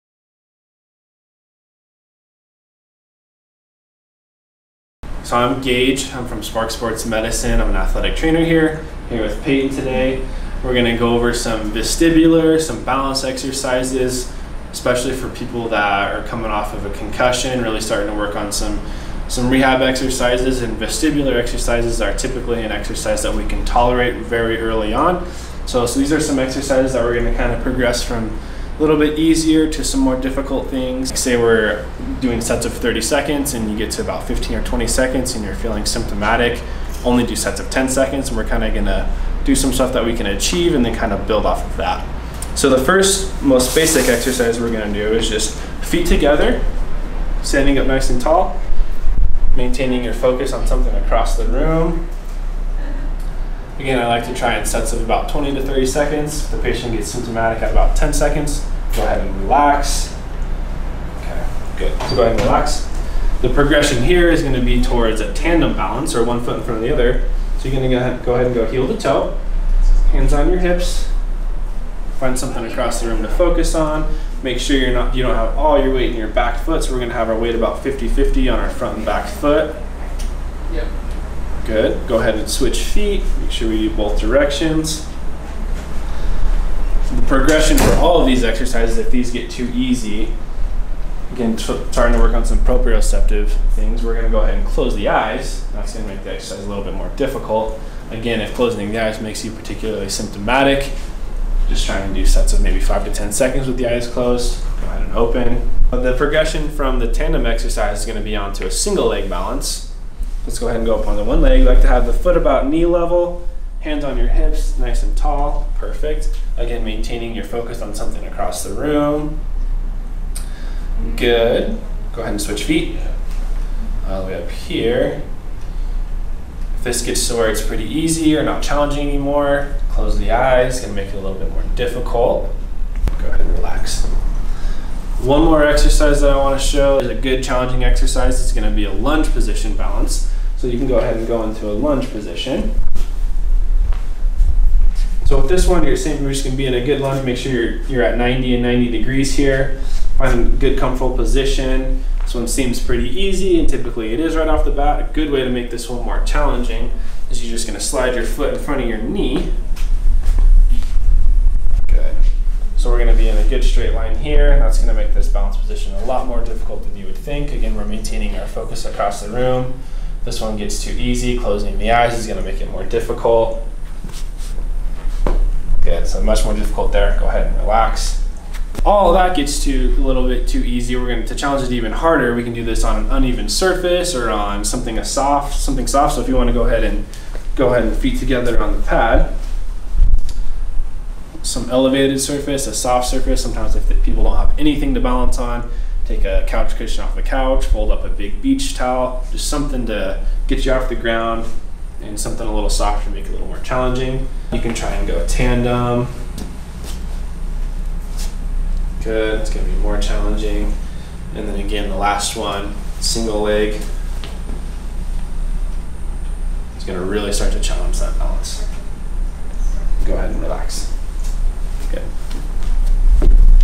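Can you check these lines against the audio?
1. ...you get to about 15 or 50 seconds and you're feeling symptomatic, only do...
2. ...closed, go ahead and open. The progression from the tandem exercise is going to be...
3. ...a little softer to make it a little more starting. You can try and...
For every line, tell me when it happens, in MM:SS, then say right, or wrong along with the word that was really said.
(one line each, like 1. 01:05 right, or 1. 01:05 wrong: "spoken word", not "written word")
1. 00:33 wrong: "20", not "50"
2. 01:44 right
3. 03:22 wrong: "challenging", not "starting".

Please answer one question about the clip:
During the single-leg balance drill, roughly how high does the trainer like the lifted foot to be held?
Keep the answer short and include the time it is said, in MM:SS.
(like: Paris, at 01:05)
knee level, at 01:52.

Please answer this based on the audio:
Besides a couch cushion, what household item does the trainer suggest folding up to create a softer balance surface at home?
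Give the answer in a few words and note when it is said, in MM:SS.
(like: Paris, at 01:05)
big beach towel, at 03:18.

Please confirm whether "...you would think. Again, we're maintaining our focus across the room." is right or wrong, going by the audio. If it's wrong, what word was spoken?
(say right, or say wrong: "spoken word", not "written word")
right.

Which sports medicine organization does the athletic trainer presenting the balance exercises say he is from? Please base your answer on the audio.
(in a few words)
SPARCC Sports Medicine.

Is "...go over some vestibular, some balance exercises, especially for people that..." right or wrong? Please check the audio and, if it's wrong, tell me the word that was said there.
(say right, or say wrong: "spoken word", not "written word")
right.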